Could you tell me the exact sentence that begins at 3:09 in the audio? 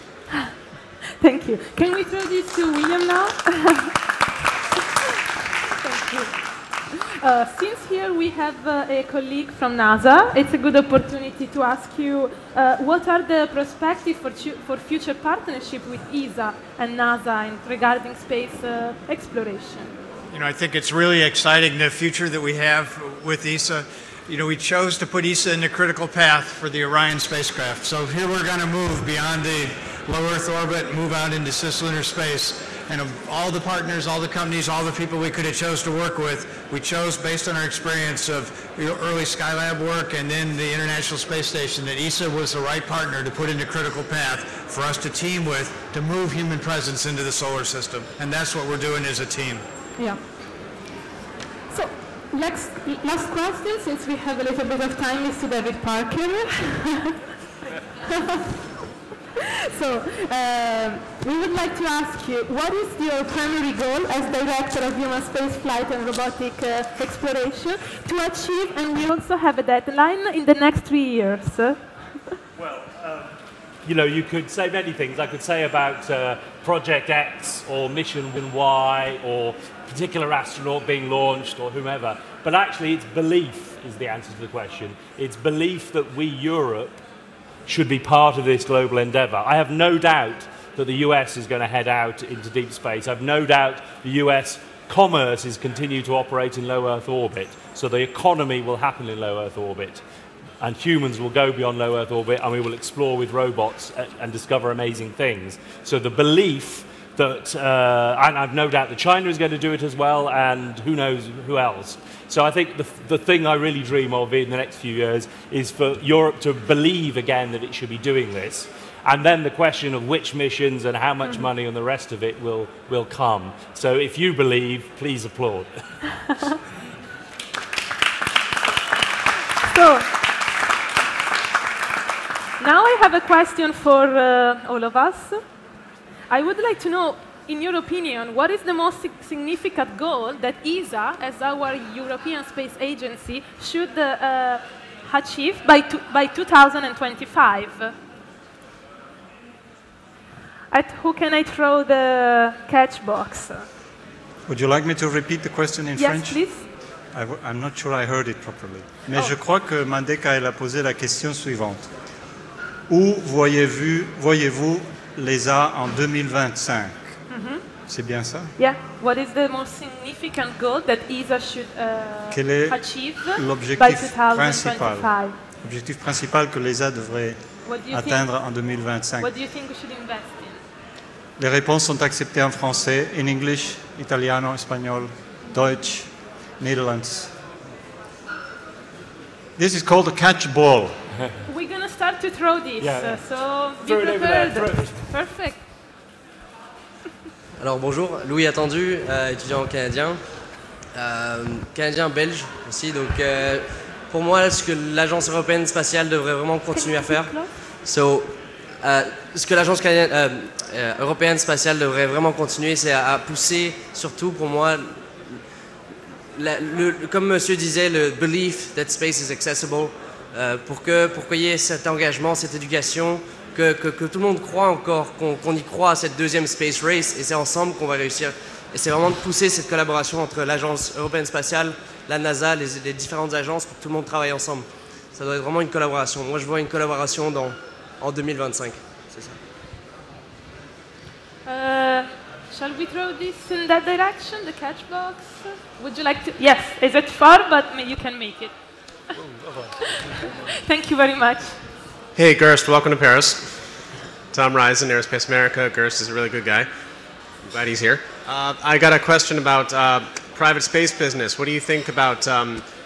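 This is called a catch ball.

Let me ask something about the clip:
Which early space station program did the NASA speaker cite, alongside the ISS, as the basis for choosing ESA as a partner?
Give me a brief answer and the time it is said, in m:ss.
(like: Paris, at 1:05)
Skylab, at 0:39.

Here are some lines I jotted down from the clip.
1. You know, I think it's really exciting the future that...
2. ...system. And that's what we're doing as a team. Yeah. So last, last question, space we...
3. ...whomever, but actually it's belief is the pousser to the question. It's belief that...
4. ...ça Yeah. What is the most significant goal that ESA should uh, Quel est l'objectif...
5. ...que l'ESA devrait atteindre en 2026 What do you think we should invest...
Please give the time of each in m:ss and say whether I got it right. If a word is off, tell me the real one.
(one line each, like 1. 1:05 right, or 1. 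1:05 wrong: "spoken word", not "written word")
1. 0:20 right
2. 0:47 wrong: "since", not "space"
3. 1:21 wrong: "answer", not "pousser"
4. 2:48 right
5. 2:56 wrong: "2025", not "2026".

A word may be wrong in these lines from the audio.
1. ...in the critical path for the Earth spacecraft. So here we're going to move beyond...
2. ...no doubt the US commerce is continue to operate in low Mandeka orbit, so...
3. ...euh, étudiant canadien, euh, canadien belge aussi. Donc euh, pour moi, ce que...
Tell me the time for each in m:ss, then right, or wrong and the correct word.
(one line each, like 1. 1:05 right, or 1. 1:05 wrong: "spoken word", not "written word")
1. 0:25 wrong: "Orion", not "Earth"
2. 1:33 wrong: "Earth", not "Mandeka"
3. 3:19 right.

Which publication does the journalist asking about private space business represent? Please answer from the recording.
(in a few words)
Aerospace America.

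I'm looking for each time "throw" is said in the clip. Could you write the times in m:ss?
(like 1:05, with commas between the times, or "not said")
0:02, 2:31, 3:12, 4:02.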